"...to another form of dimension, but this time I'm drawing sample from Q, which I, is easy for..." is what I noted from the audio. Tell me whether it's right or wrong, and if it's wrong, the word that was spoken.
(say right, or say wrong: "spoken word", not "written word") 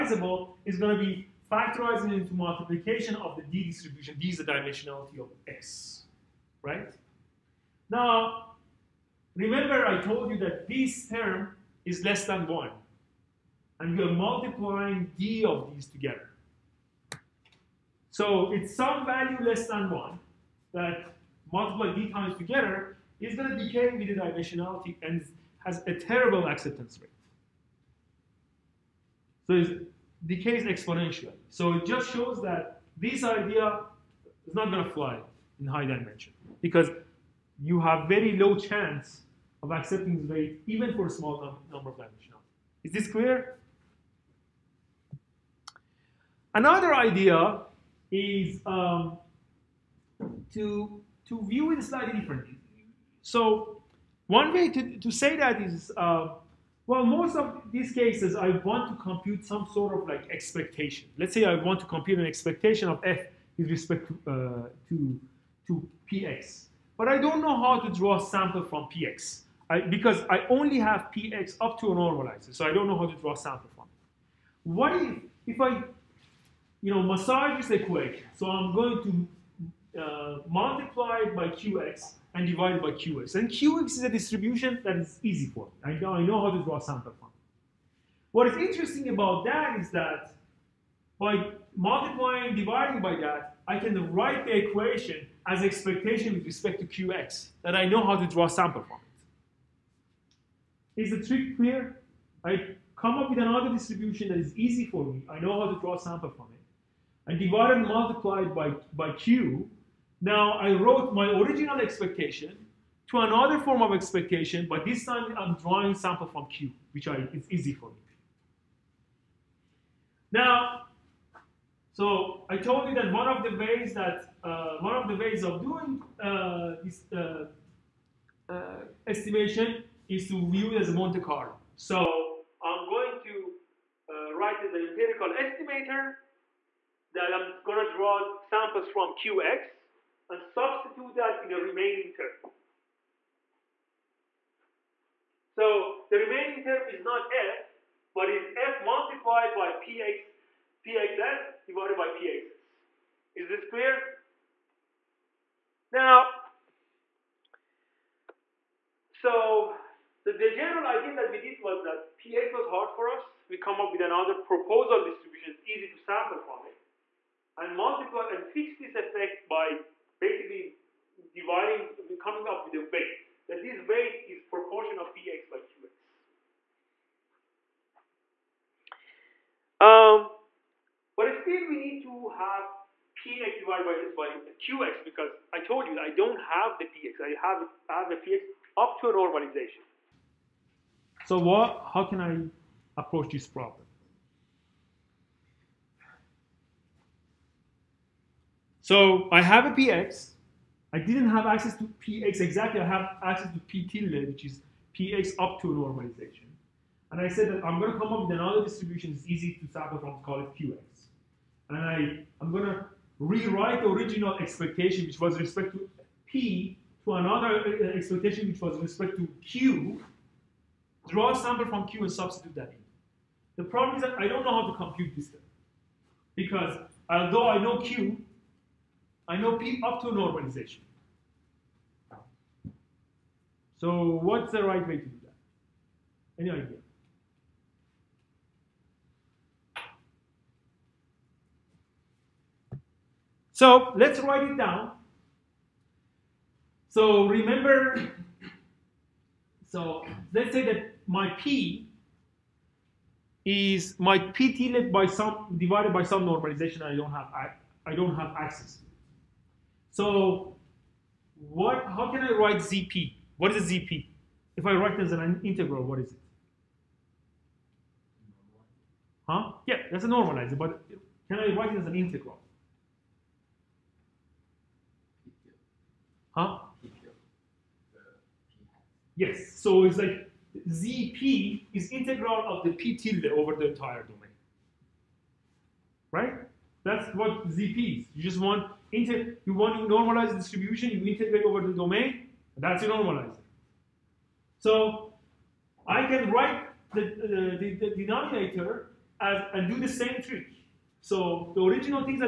wrong: "expectation", not "dimension".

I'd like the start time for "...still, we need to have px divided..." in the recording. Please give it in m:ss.
3:01.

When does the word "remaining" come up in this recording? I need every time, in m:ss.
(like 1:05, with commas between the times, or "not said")
2:21, 2:26.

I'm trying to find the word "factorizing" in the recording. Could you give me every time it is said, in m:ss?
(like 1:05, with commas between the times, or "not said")
0:01.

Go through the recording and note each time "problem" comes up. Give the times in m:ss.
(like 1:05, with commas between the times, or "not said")
3:13, 3:43.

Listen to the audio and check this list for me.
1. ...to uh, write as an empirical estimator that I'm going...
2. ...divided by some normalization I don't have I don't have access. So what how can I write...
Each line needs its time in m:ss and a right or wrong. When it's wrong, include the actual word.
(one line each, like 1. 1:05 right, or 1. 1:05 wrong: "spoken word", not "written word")
1. 2:13 right
2. 4:15 right.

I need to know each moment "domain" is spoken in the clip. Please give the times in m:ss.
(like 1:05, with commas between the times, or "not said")
4:44, 4:51.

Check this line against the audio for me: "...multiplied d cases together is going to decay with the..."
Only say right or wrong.
wrong.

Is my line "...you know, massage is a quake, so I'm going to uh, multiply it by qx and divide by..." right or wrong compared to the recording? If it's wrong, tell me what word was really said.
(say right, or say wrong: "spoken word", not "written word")
right.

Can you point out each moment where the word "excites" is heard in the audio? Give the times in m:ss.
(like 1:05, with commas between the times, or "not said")
not said.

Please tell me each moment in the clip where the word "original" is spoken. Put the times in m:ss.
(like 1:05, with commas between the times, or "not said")
1:51, 3:33, 5:01.